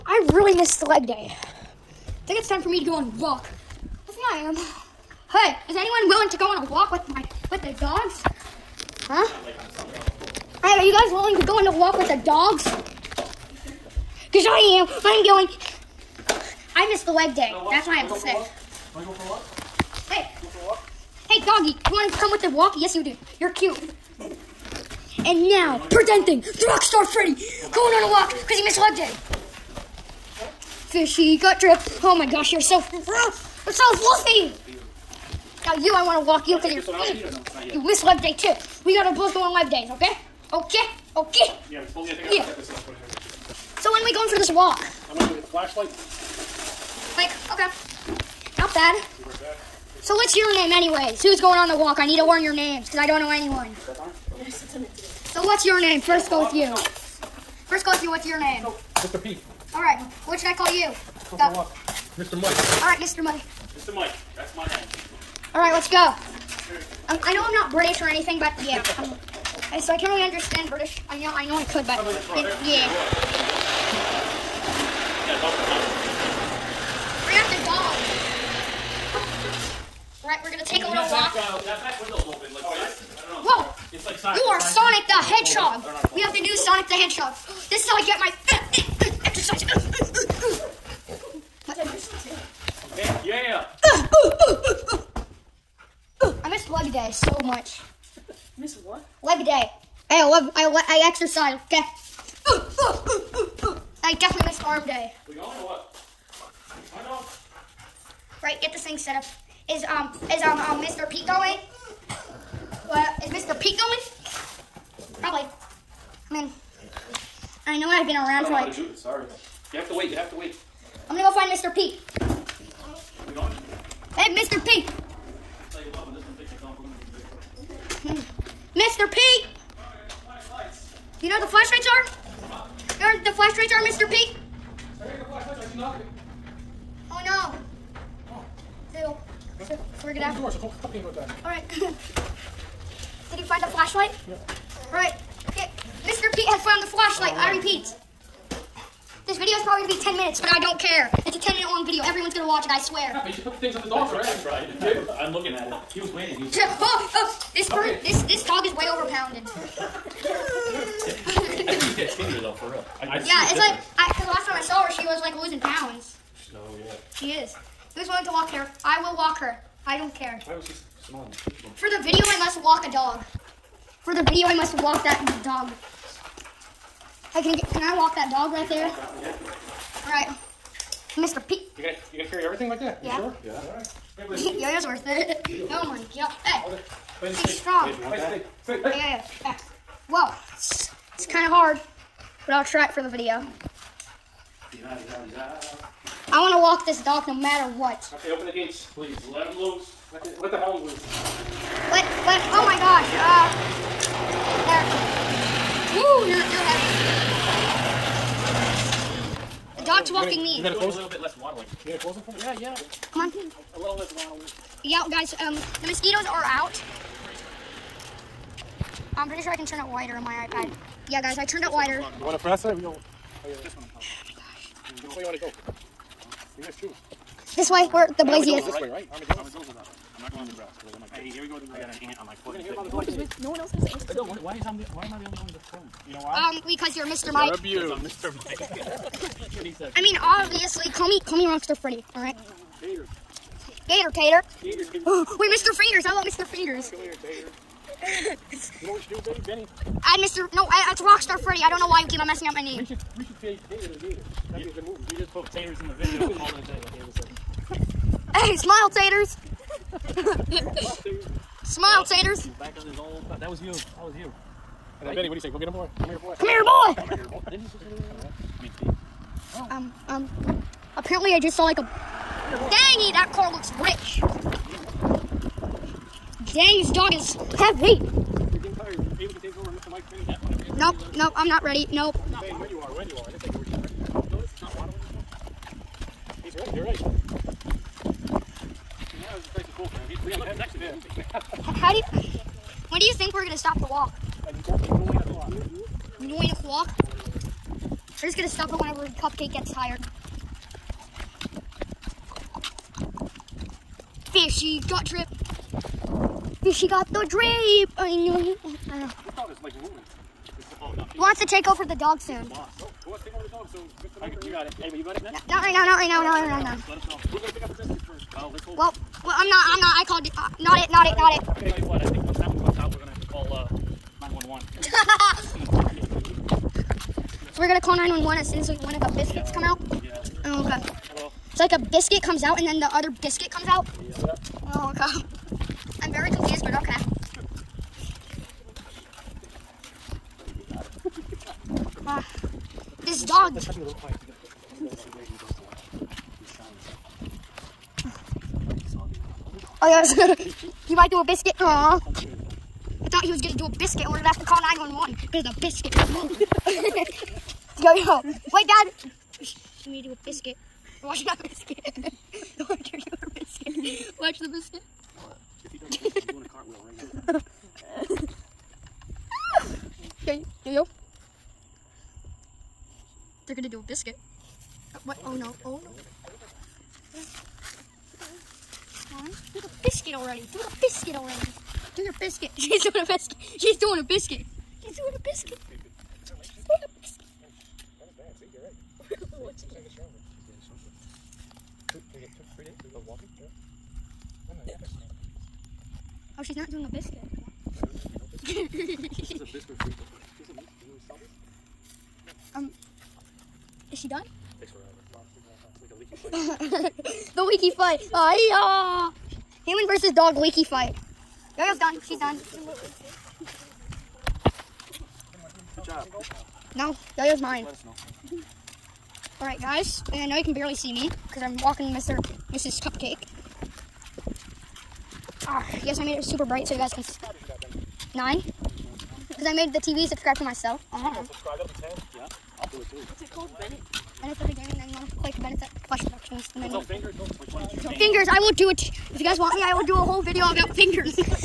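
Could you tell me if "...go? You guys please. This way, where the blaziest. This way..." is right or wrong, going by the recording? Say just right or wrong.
wrong.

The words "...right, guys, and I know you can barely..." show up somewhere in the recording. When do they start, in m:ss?
6:59.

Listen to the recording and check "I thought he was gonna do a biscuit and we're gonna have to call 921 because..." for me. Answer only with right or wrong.
wrong.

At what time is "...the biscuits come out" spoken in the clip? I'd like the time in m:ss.
5:28.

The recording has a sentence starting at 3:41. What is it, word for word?
Yeah, guys, I turned it wider.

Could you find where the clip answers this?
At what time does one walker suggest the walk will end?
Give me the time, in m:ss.
4:56.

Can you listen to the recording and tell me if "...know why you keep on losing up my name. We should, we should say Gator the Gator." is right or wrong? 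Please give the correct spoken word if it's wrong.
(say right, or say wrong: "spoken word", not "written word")
wrong: "messing", not "losing".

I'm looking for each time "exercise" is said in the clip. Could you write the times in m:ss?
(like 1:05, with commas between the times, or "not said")
1:29, 1:41.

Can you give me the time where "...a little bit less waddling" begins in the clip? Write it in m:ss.
3:30.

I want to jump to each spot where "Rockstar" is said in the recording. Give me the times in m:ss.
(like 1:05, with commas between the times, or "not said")
0:26, 4:01, 4:11.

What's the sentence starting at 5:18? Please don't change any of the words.
let's hold Well, well I'm not, I'm not, I called, uh, not it, not it, not it.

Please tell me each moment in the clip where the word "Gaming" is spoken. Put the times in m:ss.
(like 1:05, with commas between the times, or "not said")
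7:14.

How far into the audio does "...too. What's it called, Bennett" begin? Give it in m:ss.
7:12.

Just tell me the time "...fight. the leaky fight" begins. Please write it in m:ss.
6:47.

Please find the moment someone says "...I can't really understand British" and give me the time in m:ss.
1:09.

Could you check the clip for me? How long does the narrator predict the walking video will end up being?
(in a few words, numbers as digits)
10 minutes.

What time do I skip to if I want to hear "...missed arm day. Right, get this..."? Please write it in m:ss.
1:44.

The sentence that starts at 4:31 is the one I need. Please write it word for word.
Dang it, that car looks rich.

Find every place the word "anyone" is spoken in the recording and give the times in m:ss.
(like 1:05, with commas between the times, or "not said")
0:05, 0:53.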